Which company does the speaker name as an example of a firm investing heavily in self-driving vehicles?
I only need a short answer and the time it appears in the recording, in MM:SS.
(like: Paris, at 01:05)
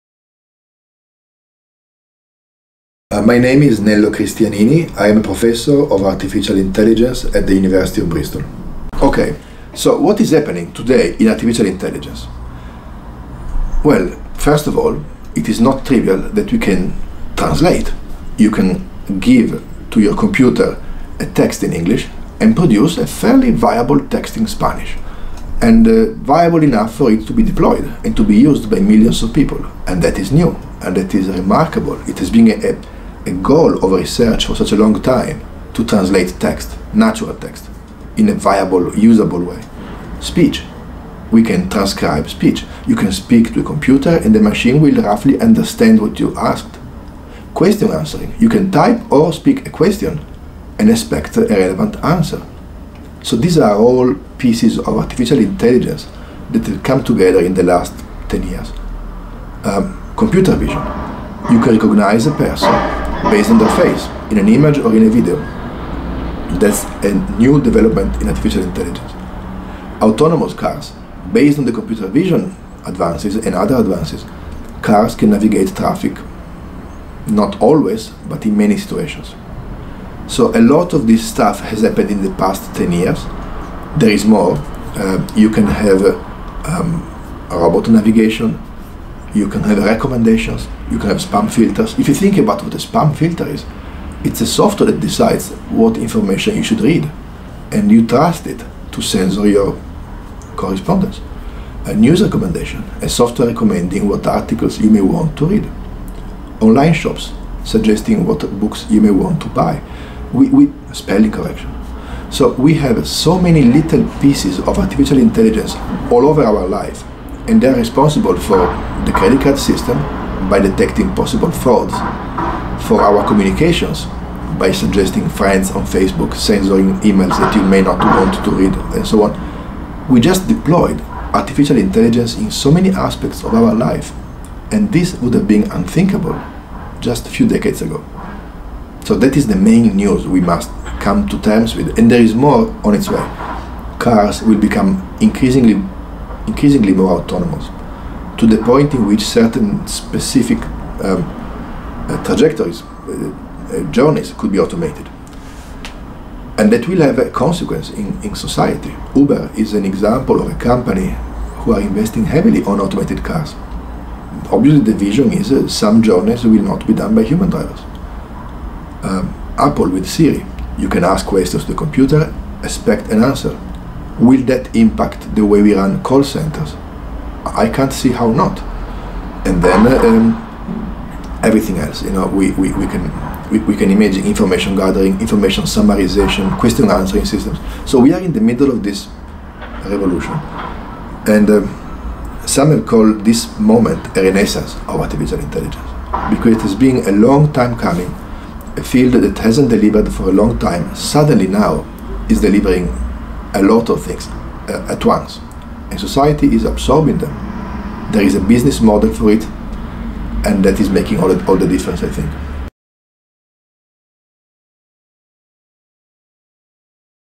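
Uber, at 02:39.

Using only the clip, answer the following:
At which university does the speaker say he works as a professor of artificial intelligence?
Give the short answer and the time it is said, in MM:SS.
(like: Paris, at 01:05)
University of Bristol, at 00:07.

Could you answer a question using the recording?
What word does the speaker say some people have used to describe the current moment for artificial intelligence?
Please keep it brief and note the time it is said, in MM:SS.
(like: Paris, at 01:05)
renaissance, at 03:14.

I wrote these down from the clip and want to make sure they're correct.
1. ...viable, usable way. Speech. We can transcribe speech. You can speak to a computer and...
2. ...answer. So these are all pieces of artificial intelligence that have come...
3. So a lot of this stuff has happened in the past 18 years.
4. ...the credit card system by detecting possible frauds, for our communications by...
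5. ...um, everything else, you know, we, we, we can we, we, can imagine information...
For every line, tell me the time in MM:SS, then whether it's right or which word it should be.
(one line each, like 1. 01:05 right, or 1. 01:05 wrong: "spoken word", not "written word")
1. 00:38 right
2. 00:52 right
3. 01:20 wrong: "10", not "18"
4. 01:59 right
5. 03:00 right.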